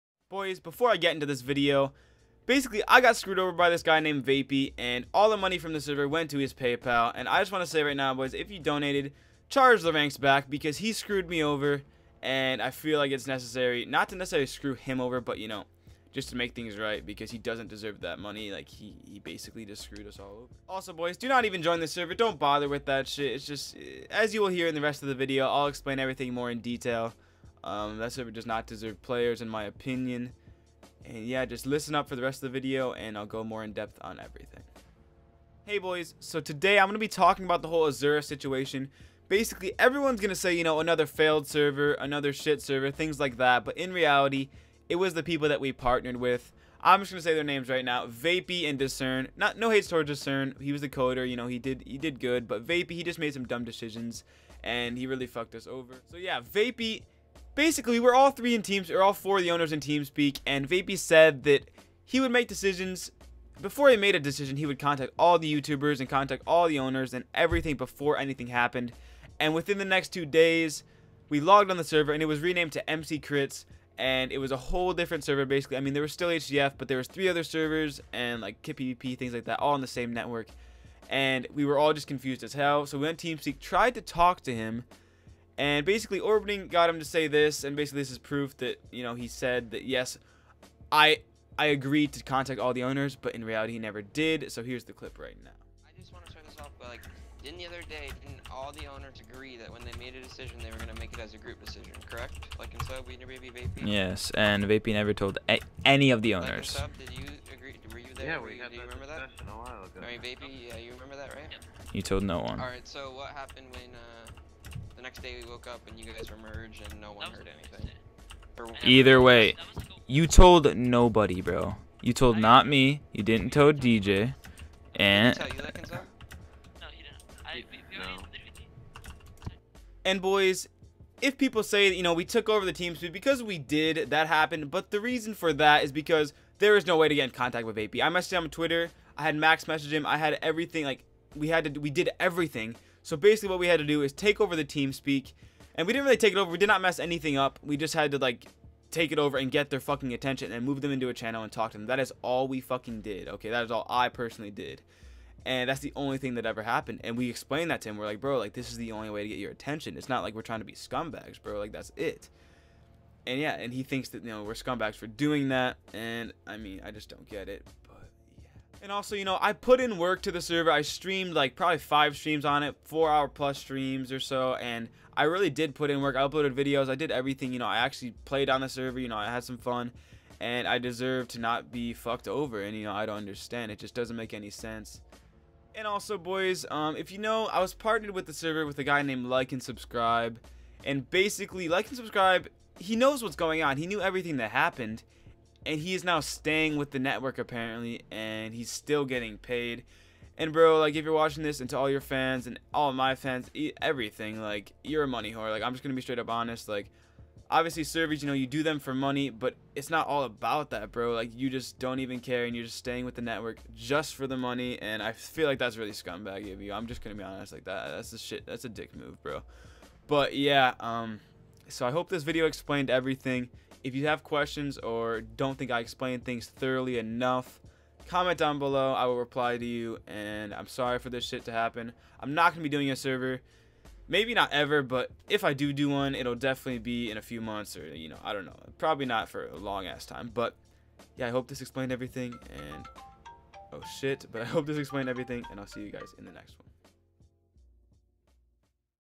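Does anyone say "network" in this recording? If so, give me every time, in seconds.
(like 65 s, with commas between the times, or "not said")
80 s, 196 s, 213 s.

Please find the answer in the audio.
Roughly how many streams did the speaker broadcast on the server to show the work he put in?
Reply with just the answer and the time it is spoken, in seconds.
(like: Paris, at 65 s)
5, at 171 s.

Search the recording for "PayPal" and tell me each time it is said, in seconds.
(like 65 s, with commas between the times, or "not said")
6 s.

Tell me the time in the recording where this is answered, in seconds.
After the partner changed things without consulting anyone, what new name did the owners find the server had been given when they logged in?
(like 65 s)
72 s.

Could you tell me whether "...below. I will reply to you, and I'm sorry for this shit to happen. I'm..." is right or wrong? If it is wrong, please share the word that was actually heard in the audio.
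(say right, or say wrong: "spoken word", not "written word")
right.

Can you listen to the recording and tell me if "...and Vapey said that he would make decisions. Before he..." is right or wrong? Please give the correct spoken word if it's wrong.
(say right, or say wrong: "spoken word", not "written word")
right.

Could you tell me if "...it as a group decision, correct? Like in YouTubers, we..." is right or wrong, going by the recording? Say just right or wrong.
wrong.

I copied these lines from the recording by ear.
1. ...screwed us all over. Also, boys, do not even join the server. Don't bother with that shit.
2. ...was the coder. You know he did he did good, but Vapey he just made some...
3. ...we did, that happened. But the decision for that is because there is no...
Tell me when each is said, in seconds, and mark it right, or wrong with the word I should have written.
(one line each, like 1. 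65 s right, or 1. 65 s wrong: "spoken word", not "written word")
1. 19 s right
2. 50 s right
3. 133 s wrong: "reason", not "decision".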